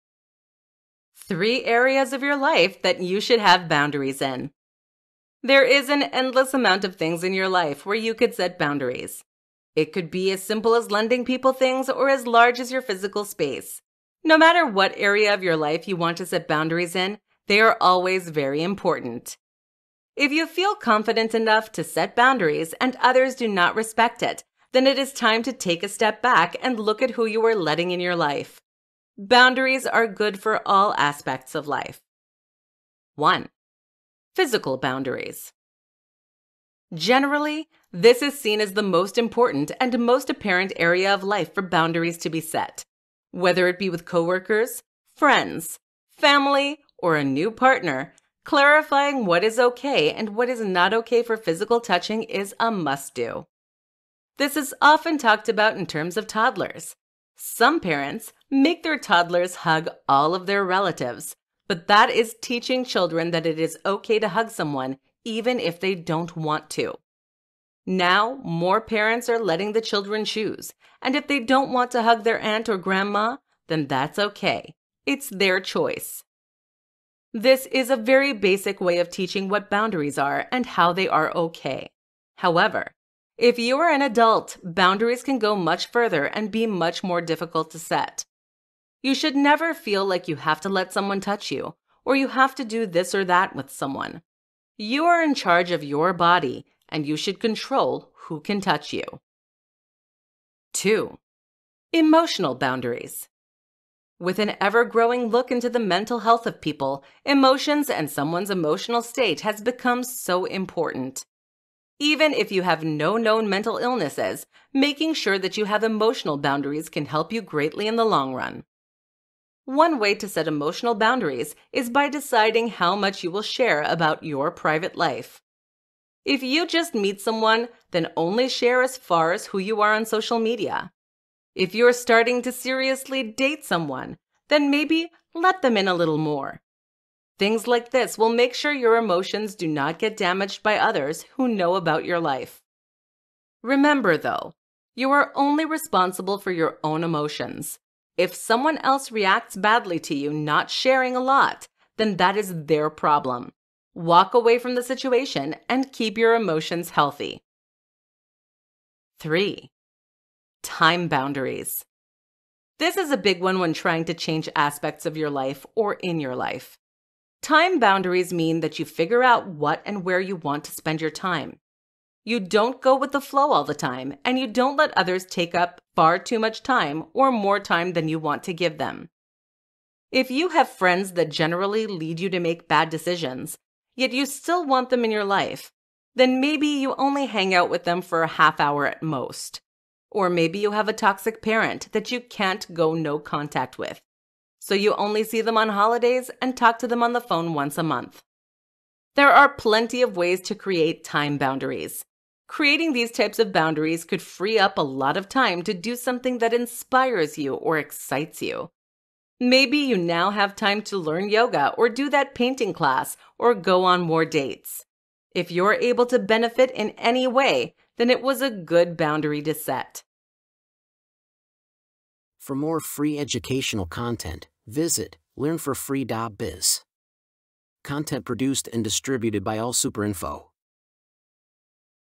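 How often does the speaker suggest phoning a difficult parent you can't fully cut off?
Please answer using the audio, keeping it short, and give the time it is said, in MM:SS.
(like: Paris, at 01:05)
once a month, at 03:17.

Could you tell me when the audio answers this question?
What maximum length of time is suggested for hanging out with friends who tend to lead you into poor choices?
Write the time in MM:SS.
03:08.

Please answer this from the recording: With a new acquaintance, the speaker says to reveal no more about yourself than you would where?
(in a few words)
social media.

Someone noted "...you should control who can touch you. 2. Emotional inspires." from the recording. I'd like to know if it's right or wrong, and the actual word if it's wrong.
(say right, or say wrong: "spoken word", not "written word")
wrong: "boundaries", not "inspires".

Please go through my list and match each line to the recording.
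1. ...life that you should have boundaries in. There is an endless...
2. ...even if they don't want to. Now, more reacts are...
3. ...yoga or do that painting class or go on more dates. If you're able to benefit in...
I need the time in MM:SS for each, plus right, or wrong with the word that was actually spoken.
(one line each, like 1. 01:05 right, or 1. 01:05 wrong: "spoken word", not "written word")
1. 00:02 right
2. 01:05 wrong: "parents", not "reacts"
3. 03:31 right.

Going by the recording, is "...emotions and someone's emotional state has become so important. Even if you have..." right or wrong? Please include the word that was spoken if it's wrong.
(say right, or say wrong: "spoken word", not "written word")
right.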